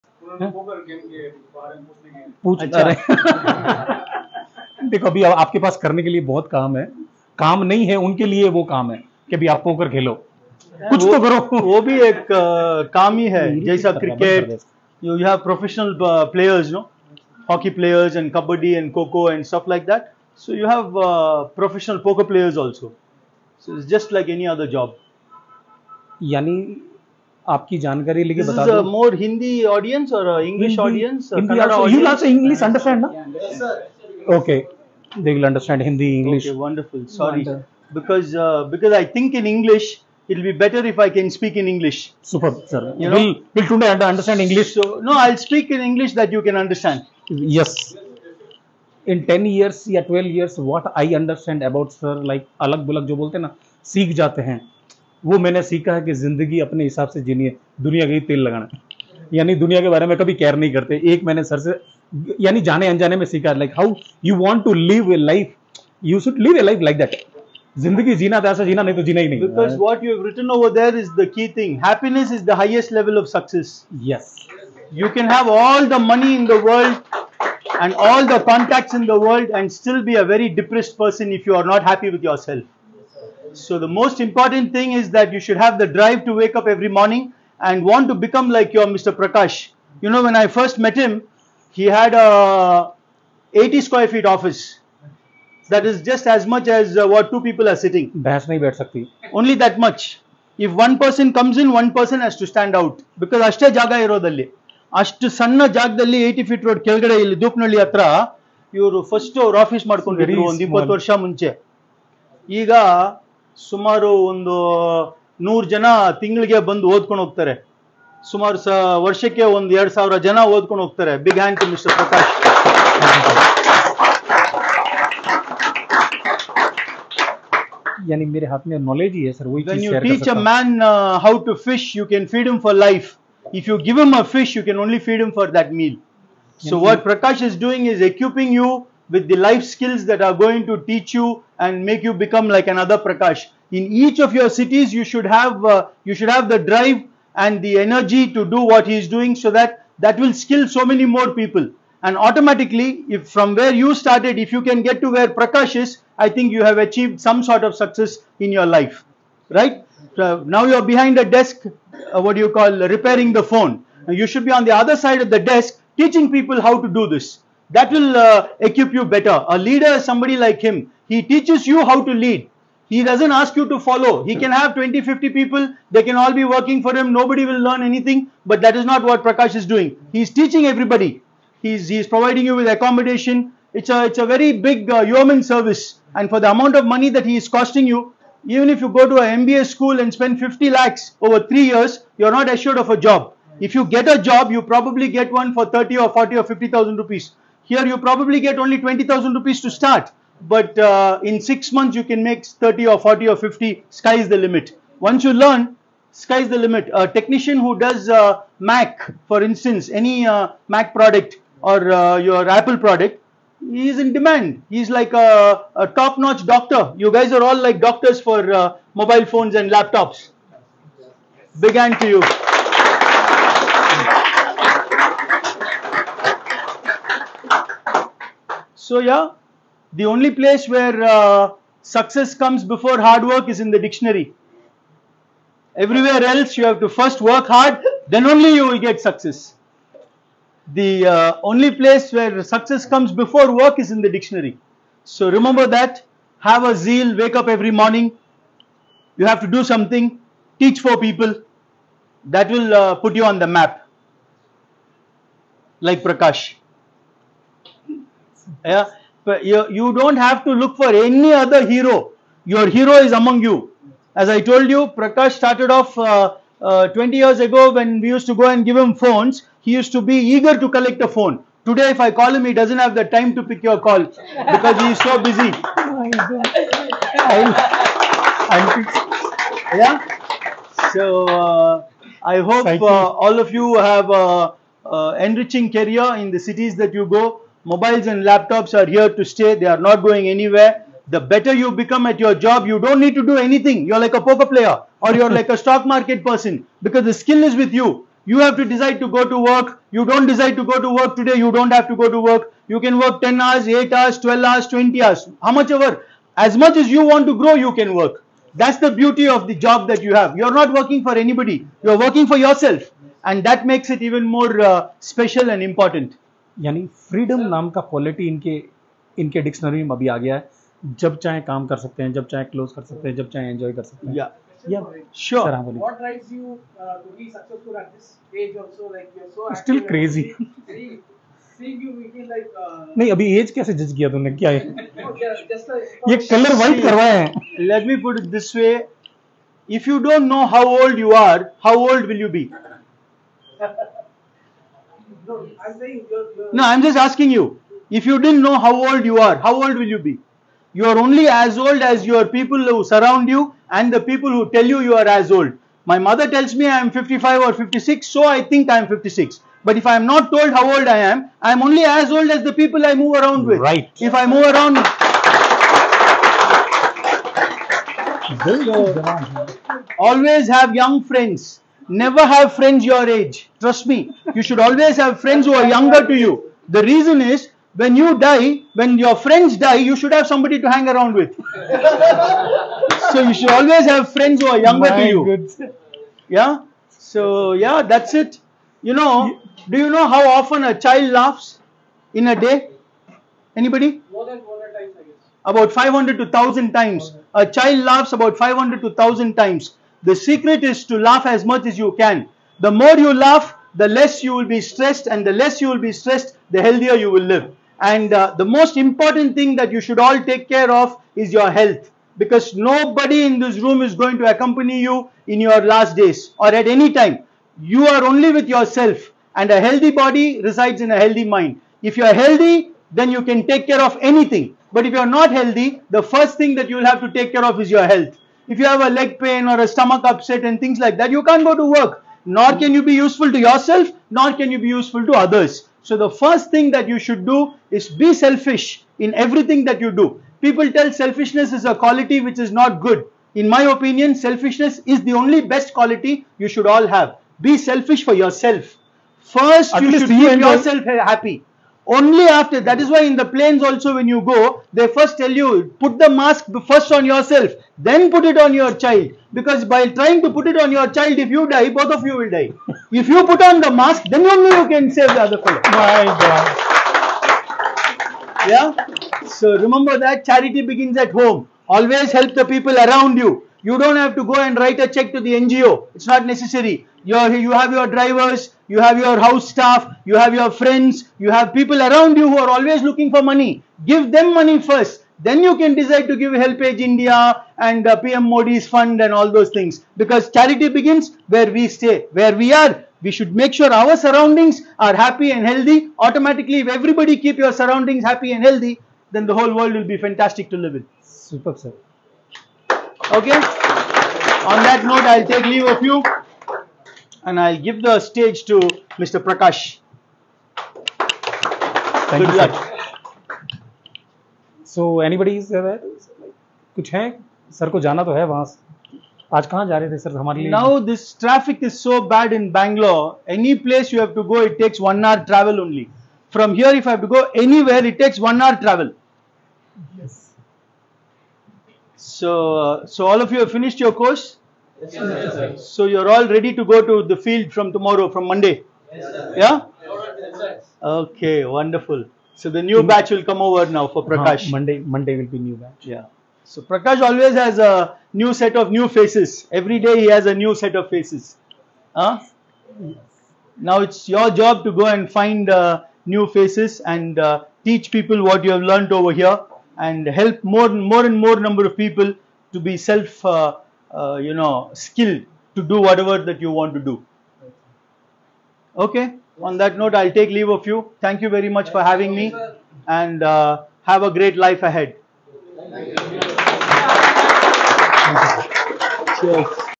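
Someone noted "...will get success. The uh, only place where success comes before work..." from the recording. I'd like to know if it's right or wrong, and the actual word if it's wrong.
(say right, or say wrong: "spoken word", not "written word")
right.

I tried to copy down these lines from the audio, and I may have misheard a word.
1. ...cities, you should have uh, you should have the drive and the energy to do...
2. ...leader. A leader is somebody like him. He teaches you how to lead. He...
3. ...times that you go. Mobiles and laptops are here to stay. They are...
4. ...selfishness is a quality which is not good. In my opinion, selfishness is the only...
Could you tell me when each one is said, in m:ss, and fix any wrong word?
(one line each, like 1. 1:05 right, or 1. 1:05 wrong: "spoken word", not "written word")
1. 2:24 right
2. 2:49 wrong: "better", not "leader"
3. 4:46 wrong: "cities", not "times"
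4. 7:20 right.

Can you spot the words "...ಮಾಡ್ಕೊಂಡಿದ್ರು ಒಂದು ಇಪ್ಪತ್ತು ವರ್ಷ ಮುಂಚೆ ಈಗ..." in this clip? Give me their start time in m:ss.
1:49.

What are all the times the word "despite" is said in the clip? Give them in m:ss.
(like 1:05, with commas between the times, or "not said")
not said.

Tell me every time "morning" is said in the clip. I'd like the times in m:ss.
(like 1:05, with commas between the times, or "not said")
1:26, 4:07.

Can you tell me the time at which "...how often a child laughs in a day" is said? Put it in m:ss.
6:30.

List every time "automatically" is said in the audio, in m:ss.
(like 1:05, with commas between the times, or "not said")
2:32, 8:15.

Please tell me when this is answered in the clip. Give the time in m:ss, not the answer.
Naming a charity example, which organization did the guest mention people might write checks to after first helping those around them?
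8:06.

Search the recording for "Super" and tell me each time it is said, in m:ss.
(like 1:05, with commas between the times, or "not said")
0:42, 8:21.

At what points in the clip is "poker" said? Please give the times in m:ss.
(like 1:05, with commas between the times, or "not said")
4:54.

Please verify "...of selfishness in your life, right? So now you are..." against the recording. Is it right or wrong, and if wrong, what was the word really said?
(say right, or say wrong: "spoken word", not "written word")
wrong: "success", not "selfishness".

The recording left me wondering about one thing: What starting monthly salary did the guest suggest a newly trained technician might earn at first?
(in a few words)
20,000 rupees.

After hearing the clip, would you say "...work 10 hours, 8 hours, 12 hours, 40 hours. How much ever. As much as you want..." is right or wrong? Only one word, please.
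wrong.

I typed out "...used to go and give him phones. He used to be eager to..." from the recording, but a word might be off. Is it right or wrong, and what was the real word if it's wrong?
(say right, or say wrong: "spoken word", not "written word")
right.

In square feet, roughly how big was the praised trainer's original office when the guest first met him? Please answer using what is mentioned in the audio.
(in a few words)
80 square feet.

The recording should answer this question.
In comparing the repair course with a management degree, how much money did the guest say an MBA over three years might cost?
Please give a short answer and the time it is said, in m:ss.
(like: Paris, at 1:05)
50 lakhs, at 3:10.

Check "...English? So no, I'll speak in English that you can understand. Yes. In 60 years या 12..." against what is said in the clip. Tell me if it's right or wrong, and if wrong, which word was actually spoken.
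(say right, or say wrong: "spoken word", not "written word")
wrong: "10", not "60".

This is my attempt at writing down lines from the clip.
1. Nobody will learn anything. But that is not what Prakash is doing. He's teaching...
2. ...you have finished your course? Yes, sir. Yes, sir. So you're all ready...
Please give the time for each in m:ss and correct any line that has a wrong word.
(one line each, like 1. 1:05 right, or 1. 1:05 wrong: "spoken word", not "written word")
1. 2:57 right
2. 8:53 right.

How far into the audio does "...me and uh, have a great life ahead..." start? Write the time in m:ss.
9:32.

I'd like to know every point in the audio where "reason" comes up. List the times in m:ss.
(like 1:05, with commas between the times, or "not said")
6:16.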